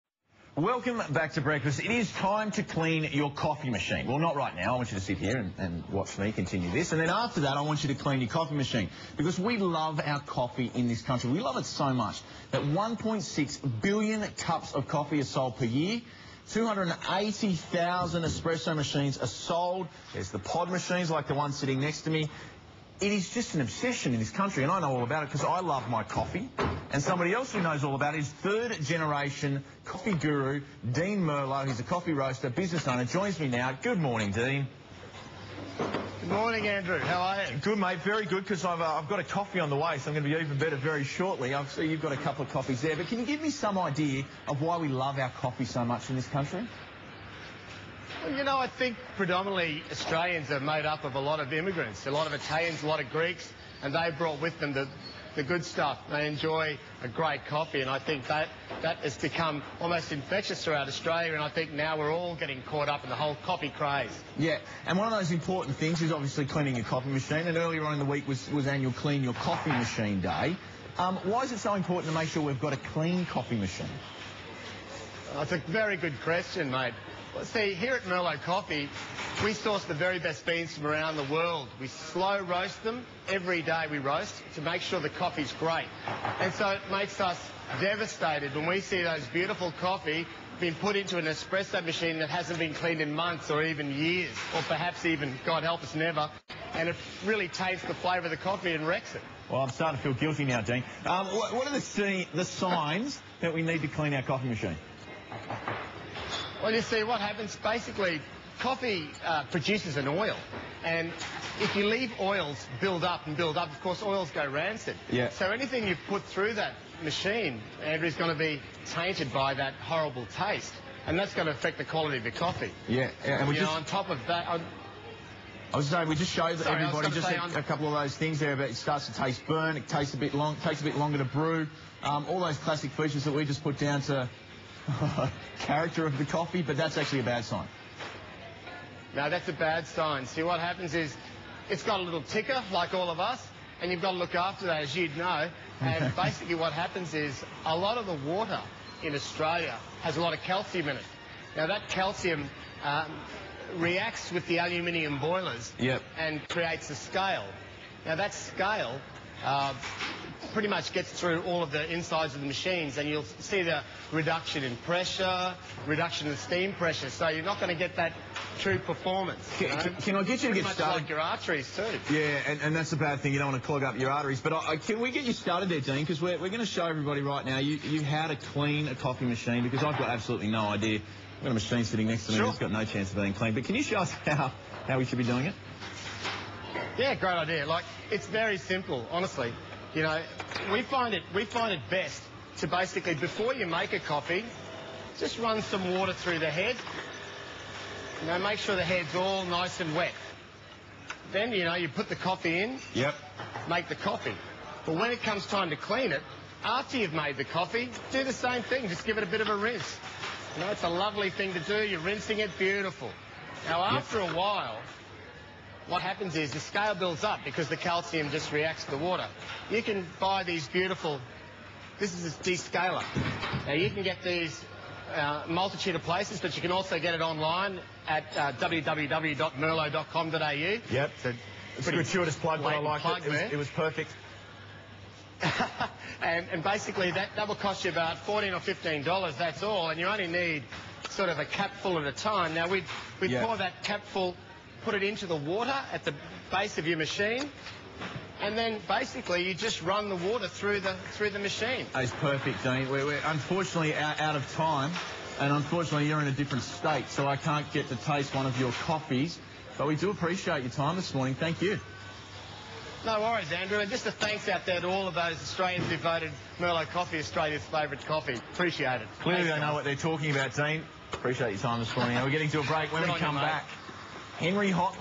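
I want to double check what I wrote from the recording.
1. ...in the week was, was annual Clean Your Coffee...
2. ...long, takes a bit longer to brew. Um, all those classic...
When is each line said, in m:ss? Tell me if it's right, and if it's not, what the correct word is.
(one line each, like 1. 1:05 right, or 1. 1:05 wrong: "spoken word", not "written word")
1. 1:07 right
2. 2:10 right.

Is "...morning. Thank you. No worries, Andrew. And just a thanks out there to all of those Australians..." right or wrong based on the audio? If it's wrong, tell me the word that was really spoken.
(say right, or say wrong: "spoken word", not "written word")
right.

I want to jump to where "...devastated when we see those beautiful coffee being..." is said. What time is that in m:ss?
1:27.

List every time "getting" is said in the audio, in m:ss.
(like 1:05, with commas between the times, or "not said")
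1:02, 4:32.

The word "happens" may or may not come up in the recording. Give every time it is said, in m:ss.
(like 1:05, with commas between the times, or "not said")
1:47, 2:20, 2:26, 3:36.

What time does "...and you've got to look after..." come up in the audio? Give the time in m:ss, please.
2:23.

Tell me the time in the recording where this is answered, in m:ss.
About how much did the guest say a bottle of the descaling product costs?
3:58.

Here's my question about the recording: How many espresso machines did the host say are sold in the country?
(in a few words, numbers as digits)
280,000.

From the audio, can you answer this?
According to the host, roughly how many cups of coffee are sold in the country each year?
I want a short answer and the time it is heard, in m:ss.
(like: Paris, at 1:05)
1.6 billion, at 0:12.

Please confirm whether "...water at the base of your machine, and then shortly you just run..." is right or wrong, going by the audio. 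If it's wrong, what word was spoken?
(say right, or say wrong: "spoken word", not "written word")
wrong: "basically", not "shortly".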